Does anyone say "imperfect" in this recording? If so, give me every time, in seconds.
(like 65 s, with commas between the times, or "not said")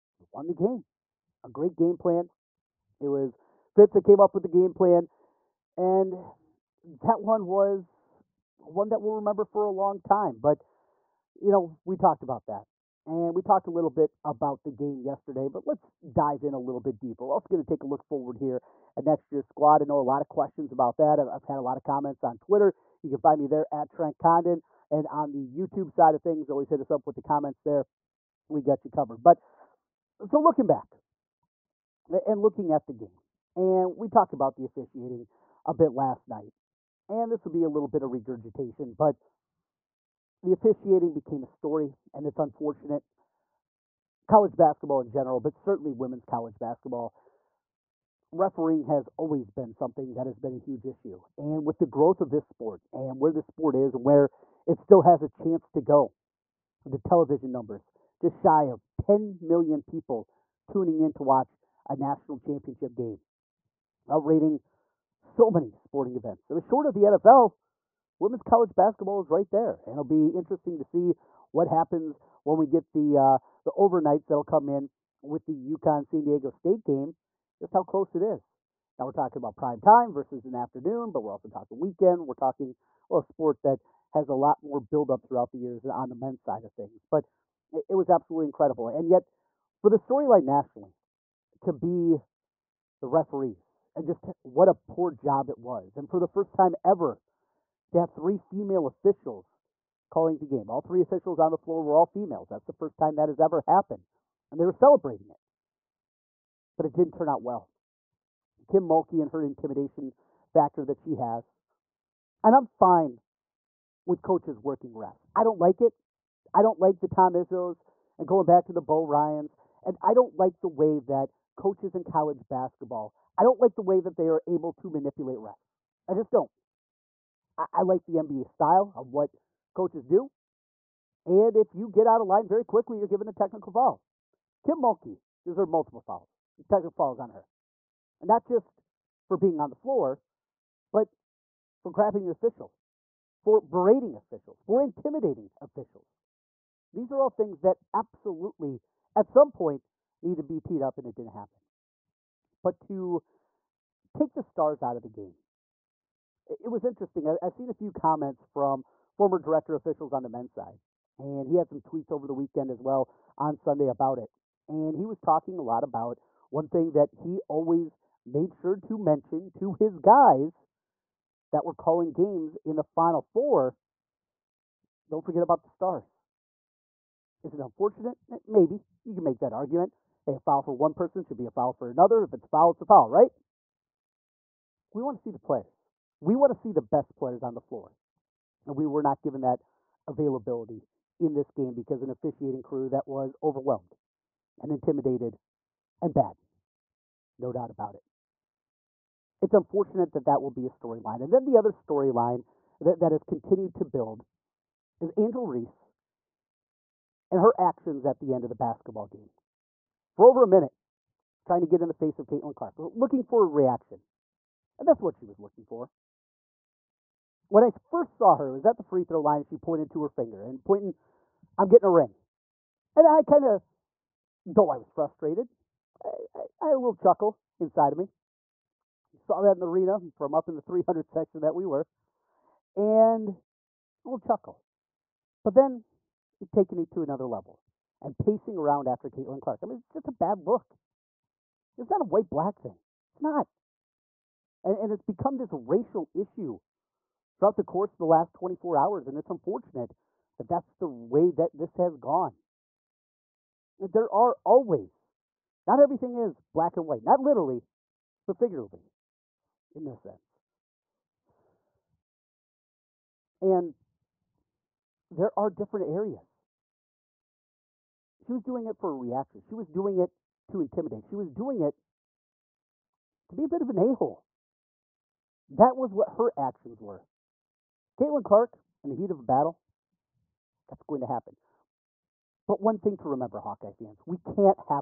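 not said.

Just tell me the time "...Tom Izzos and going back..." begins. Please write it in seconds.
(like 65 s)
117 s.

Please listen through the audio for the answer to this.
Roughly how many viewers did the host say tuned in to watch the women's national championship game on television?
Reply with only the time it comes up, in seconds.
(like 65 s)
58 s.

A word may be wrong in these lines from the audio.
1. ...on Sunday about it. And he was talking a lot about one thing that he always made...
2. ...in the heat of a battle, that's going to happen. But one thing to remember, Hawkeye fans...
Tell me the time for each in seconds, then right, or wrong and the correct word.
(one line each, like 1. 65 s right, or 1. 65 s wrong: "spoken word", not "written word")
1. 163 s right
2. 278 s right.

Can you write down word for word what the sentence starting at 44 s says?
College basketball in general, but certainly women's college basketball, refereeing has always been something that has been a huge issue.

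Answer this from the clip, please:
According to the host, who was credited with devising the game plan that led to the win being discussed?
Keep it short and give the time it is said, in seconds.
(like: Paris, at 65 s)
Fitz, at 3 s.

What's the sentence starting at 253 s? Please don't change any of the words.
There are always, not everything is black and white, not literally, but figuratively in this sense.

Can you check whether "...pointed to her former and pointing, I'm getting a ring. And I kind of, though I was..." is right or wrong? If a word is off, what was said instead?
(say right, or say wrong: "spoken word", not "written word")
wrong: "finger", not "former".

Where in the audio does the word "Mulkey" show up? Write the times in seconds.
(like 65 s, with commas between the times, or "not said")
108 s, 134 s.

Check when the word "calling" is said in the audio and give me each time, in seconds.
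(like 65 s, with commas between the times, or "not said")
100 s, 171 s.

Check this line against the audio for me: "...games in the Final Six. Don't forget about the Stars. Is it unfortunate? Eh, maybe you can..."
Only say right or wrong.
wrong.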